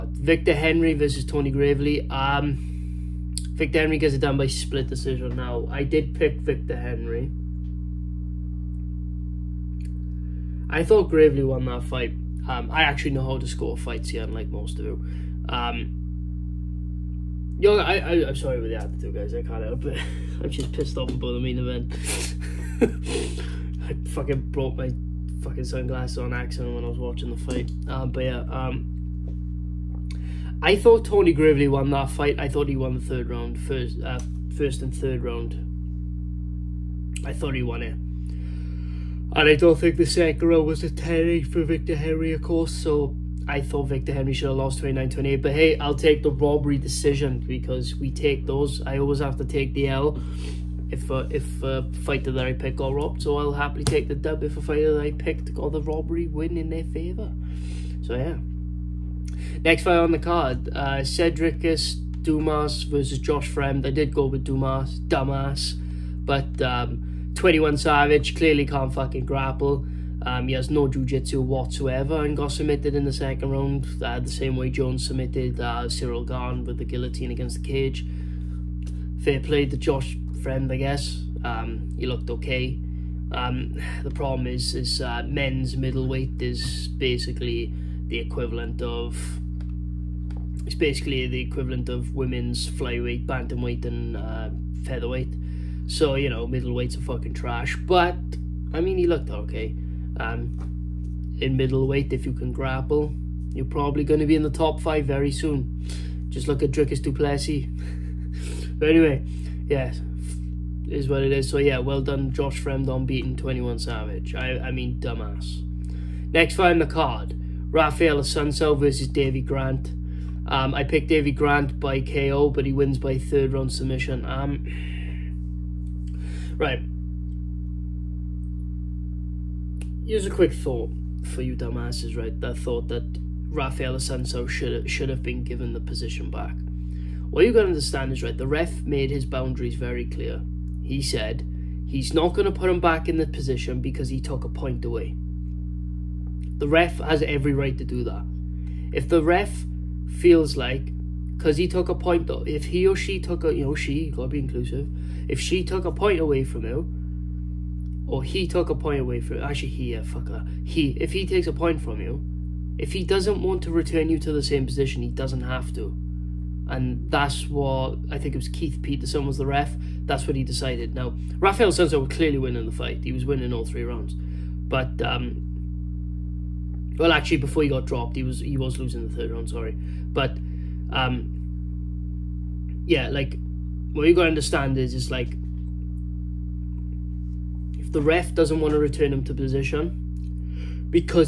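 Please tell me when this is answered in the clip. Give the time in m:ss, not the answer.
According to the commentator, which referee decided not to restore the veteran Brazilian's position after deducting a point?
2:48.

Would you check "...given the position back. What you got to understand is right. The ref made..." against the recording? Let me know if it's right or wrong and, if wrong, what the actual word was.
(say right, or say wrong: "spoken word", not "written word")
right.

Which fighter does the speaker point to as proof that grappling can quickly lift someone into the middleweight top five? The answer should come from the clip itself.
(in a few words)
Dricus Du Plessis.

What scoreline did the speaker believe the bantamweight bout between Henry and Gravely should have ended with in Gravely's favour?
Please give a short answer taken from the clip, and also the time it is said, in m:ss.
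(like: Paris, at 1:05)
29-28, at 0:44.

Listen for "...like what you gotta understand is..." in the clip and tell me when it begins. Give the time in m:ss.
3:03.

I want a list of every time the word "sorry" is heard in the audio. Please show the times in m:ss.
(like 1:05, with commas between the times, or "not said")
0:18, 2:59.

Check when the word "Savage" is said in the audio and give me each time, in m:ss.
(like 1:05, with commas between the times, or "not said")
1:07, 1:53.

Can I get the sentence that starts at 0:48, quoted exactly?
I always have to take the L if a, uh, if a uh, fighter that I pick got robbed.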